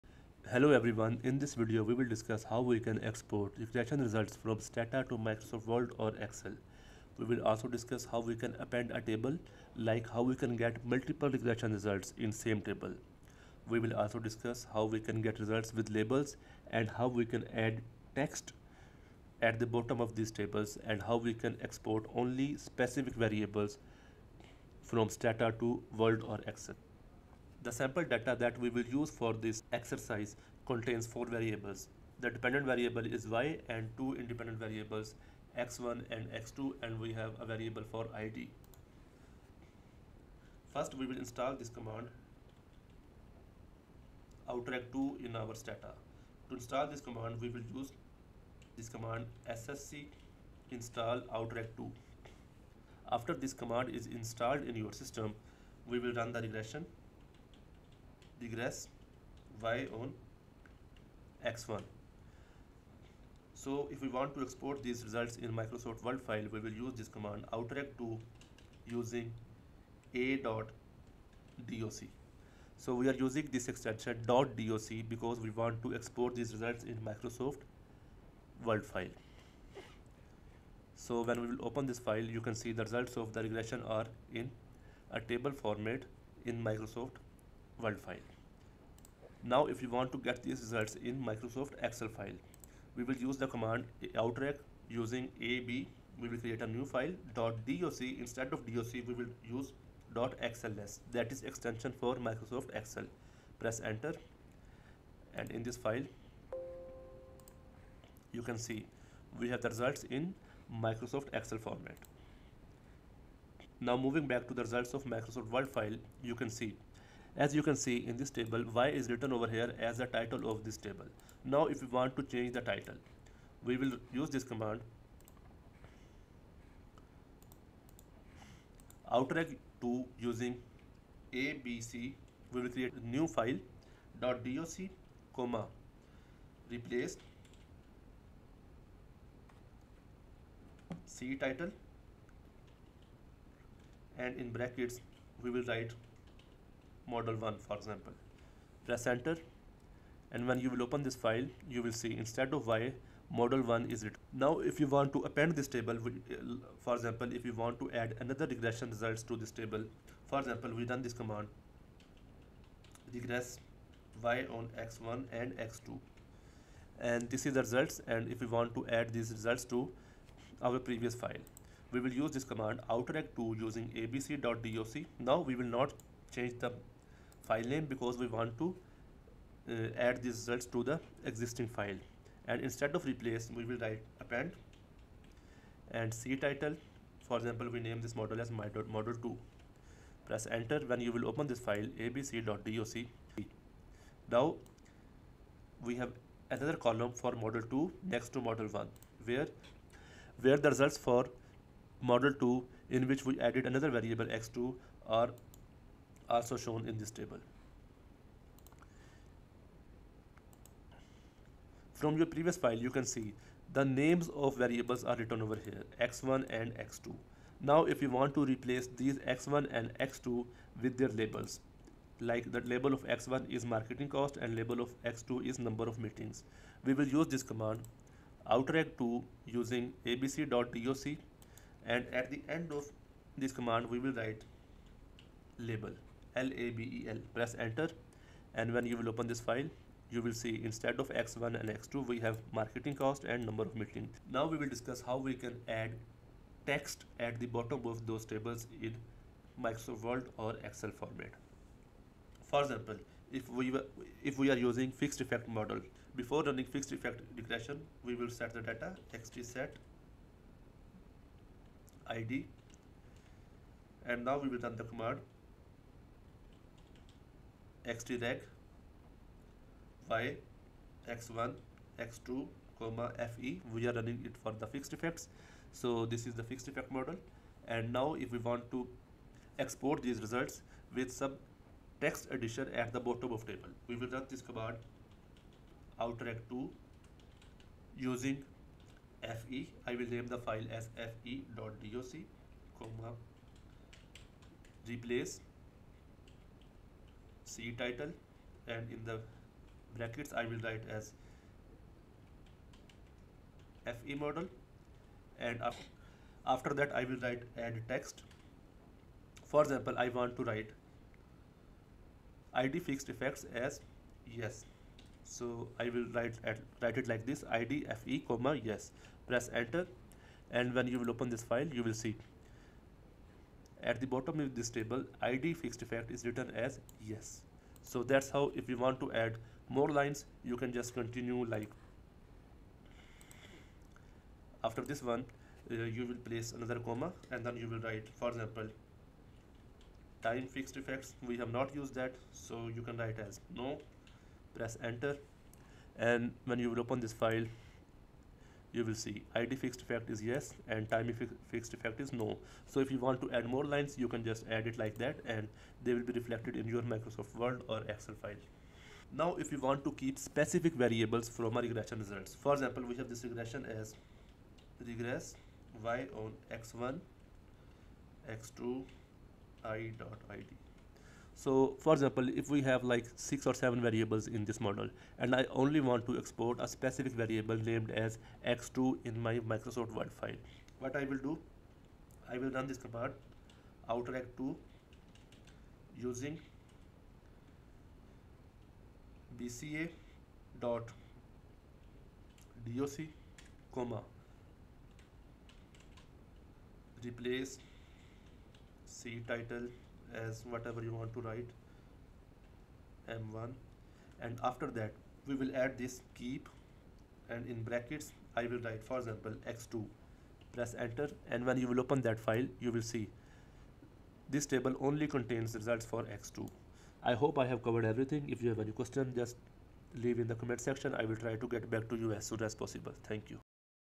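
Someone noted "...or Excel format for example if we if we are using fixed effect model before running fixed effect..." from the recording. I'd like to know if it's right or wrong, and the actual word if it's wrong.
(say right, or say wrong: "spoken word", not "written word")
right.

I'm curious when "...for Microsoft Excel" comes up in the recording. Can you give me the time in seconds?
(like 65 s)
101 s.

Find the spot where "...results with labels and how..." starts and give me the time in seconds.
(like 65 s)
15 s.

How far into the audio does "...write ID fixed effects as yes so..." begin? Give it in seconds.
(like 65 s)
310 s.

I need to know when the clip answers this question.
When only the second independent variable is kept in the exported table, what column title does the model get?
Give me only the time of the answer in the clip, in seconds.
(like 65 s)
403 s.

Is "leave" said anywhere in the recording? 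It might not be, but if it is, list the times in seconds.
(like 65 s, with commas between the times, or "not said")
419 s.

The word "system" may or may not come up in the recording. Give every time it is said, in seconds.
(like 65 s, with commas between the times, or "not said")
54 s.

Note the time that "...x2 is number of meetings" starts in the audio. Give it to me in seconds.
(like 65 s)
225 s.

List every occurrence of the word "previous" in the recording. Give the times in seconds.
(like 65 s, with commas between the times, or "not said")
170 s, 212 s.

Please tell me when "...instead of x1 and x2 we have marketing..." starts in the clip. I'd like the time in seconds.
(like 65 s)
240 s.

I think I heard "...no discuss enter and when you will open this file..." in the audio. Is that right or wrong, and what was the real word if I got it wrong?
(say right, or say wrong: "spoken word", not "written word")
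wrong: "press", not "discuss".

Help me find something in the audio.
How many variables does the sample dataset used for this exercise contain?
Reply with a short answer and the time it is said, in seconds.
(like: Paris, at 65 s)
4, at 31 s.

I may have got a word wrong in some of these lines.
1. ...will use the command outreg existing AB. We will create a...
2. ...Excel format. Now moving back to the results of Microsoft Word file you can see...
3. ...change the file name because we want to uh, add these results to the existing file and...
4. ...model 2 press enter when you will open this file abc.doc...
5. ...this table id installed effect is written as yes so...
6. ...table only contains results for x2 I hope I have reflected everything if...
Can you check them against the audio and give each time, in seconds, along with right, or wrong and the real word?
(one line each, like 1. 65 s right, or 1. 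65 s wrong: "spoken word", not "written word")
1. 93 s wrong: "using", not "existing"
2. 111 s right
3. 176 s right
4. 188 s right
5. 324 s wrong: "fixed", not "installed"
6. 414 s wrong: "covered", not "reflected".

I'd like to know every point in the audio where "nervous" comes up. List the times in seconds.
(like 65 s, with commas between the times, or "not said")
not said.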